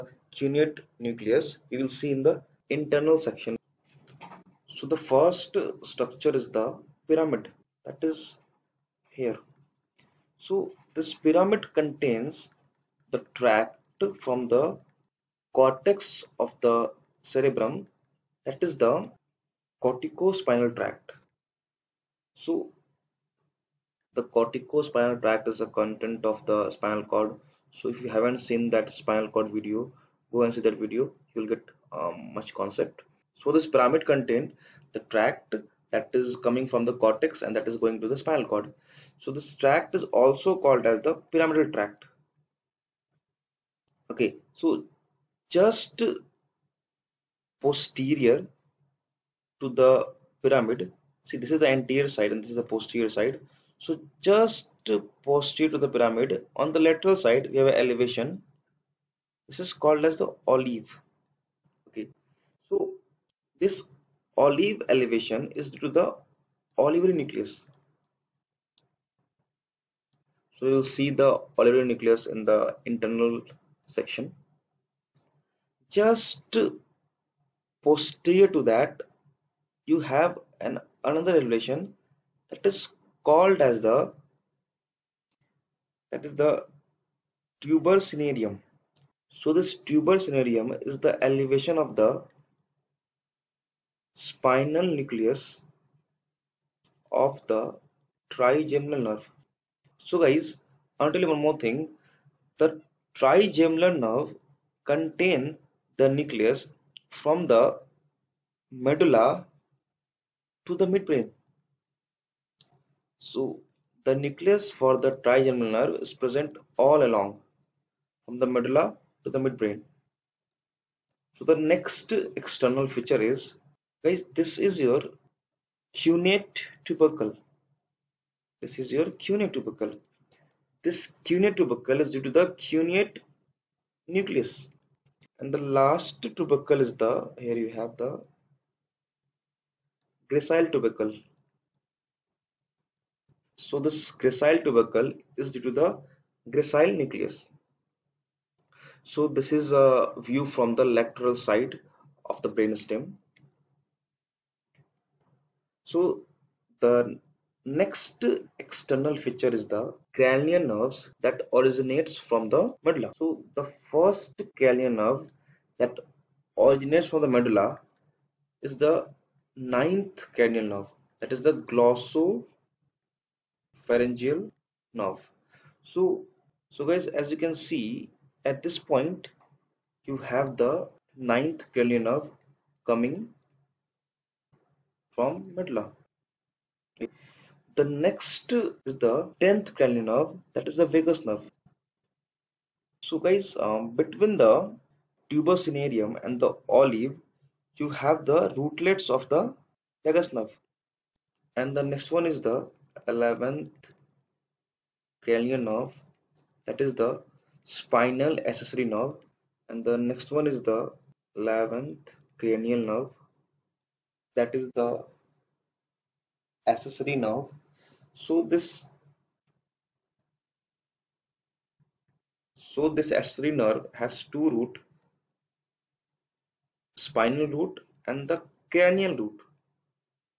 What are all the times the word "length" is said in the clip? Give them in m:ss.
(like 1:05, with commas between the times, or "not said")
not said.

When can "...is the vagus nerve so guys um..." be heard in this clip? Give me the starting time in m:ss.
3:10.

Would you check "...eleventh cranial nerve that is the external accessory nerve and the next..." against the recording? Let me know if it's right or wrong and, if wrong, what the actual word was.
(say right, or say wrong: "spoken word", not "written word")
wrong: "spinal", not "external".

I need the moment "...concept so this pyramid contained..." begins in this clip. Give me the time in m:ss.
0:32.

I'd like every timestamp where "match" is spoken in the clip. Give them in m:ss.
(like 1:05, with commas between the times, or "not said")
not said.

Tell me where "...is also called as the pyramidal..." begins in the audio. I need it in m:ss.
0:39.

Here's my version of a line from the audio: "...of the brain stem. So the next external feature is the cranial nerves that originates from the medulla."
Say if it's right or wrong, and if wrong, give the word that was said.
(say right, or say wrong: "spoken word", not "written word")
right.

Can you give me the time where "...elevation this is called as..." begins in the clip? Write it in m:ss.
0:57.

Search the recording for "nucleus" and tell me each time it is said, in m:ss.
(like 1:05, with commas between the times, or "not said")
0:01, 1:07, 1:11, 1:34, 1:46, 1:54, 2:14, 2:26.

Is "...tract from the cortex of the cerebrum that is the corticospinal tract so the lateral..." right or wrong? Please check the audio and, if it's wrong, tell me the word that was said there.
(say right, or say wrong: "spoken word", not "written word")
wrong: "corticospinal", not "lateral".